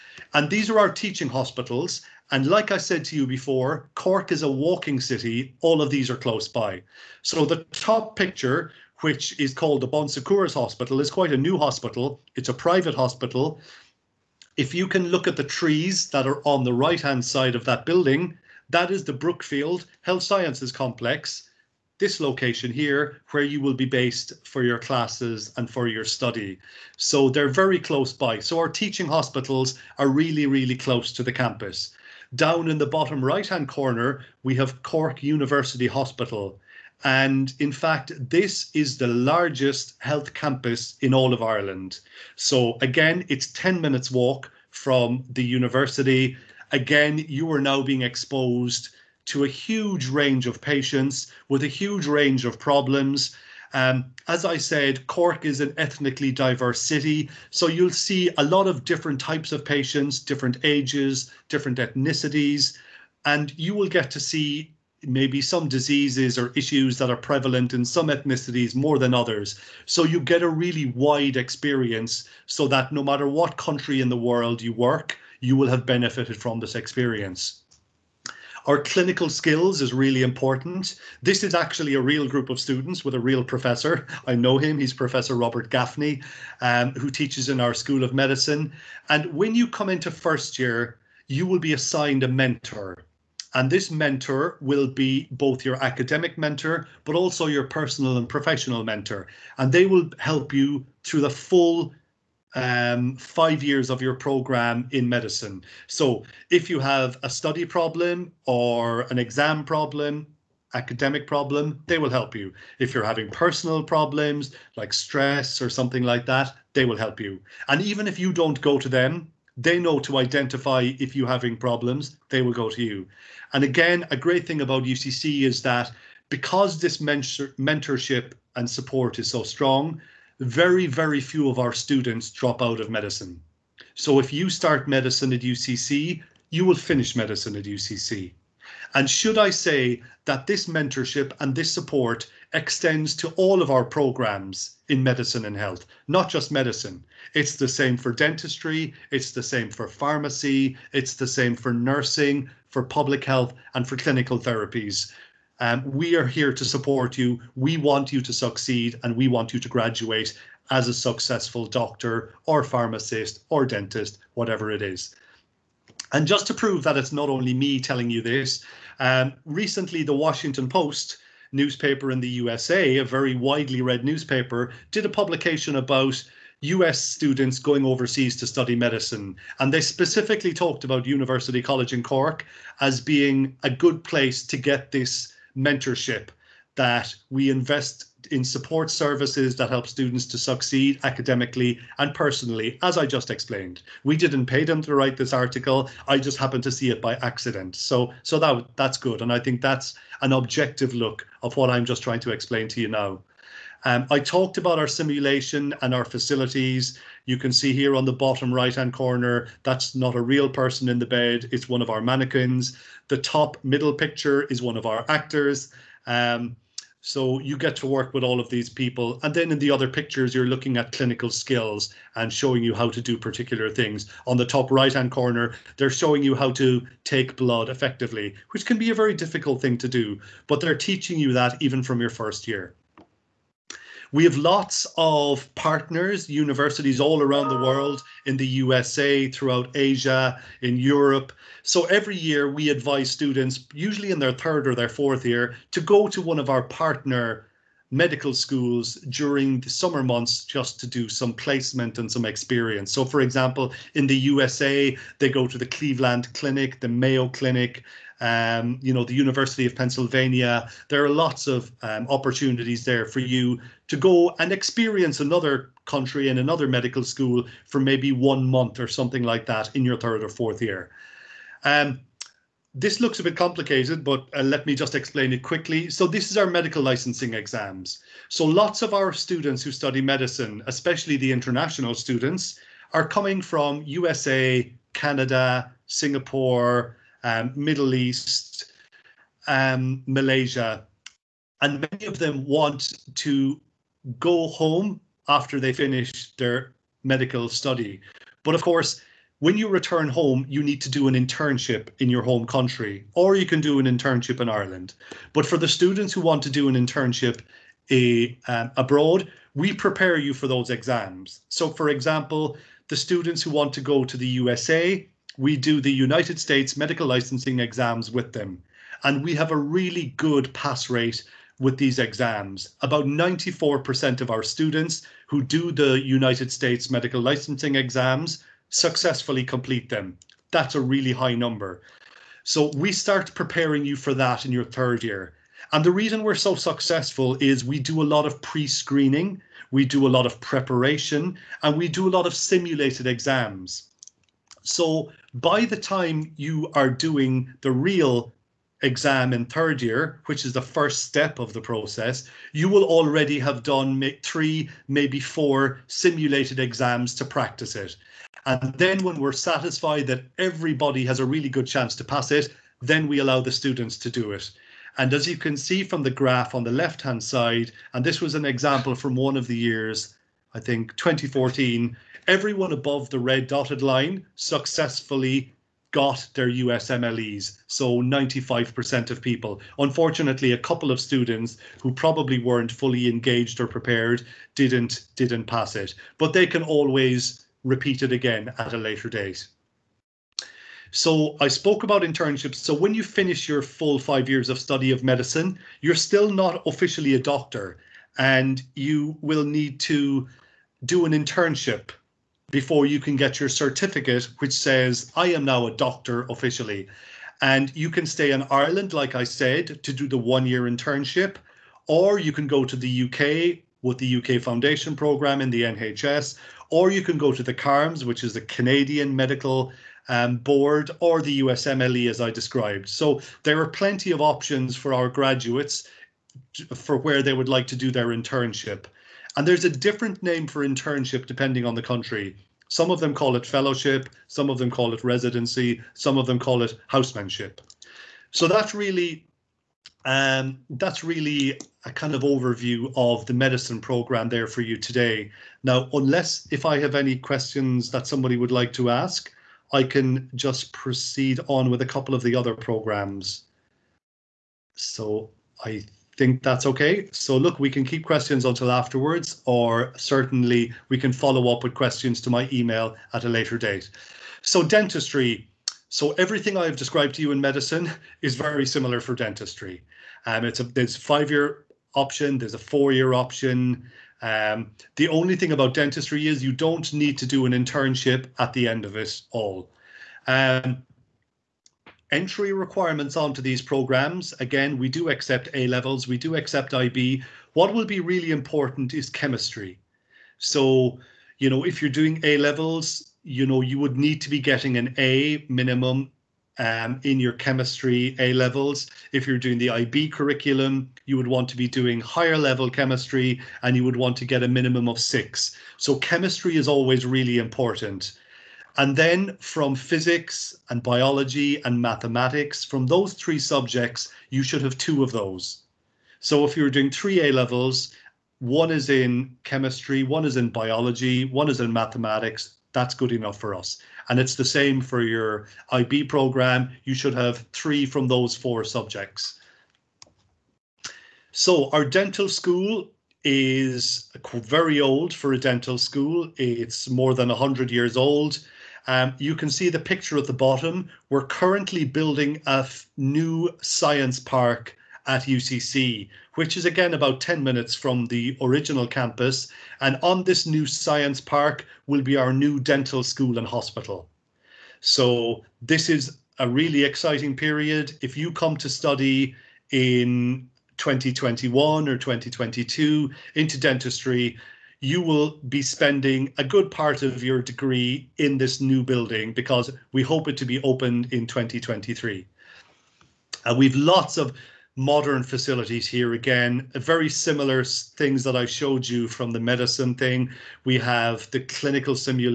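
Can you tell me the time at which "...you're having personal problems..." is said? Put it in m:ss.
1:52.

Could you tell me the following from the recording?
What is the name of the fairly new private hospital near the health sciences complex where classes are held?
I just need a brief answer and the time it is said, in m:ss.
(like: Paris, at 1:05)
Bon Secours Hospital, at 0:09.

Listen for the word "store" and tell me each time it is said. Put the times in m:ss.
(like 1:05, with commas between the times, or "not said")
not said.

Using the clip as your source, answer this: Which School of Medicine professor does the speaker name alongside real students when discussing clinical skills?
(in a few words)
Robert Gaffney.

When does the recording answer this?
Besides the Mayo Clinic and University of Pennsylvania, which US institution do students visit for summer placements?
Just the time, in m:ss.
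4:15.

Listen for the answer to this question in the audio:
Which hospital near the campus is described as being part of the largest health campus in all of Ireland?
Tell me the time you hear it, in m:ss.
0:34.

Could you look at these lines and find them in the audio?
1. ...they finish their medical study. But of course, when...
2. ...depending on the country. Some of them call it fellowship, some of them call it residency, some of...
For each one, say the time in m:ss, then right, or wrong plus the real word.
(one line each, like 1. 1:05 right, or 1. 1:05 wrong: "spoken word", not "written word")
1. 4:55 right
2. 7:11 right.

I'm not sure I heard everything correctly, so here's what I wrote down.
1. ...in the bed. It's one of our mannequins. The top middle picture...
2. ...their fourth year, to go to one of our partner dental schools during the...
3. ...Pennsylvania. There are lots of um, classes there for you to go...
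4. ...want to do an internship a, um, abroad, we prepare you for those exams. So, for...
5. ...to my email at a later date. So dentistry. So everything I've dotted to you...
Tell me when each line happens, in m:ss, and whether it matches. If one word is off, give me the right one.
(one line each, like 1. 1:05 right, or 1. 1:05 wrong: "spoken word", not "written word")
1. 3:30 right
2. 4:04 wrong: "medical", not "dental"
3. 4:19 wrong: "opportunities", not "classes"
4. 5:06 right
5. 7:42 wrong: "described", not "dotted".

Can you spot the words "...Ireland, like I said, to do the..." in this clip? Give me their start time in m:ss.
6:48.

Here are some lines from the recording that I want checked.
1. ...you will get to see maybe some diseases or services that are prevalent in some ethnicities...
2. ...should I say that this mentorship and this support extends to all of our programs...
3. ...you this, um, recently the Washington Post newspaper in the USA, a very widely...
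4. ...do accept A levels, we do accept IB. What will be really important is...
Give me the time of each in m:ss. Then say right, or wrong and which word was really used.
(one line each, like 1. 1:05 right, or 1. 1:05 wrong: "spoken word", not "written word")
1. 1:03 wrong: "issues", not "services"
2. 2:19 right
3. 2:48 right
4. 8:04 right.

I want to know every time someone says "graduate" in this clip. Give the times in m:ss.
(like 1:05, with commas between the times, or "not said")
2:39, 7:05.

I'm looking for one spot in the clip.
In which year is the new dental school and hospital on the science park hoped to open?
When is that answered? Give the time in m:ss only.
9:31.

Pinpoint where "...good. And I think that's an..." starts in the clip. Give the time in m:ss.
3:18.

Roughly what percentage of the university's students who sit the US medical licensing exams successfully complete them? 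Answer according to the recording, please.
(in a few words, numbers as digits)
94%.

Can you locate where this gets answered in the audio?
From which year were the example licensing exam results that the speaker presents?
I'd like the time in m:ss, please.
6:10.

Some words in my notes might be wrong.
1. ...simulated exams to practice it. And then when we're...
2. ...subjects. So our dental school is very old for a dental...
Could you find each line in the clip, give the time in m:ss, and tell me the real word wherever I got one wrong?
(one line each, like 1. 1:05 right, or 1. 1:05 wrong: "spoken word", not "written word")
1. 5:55 right
2. 8:48 right.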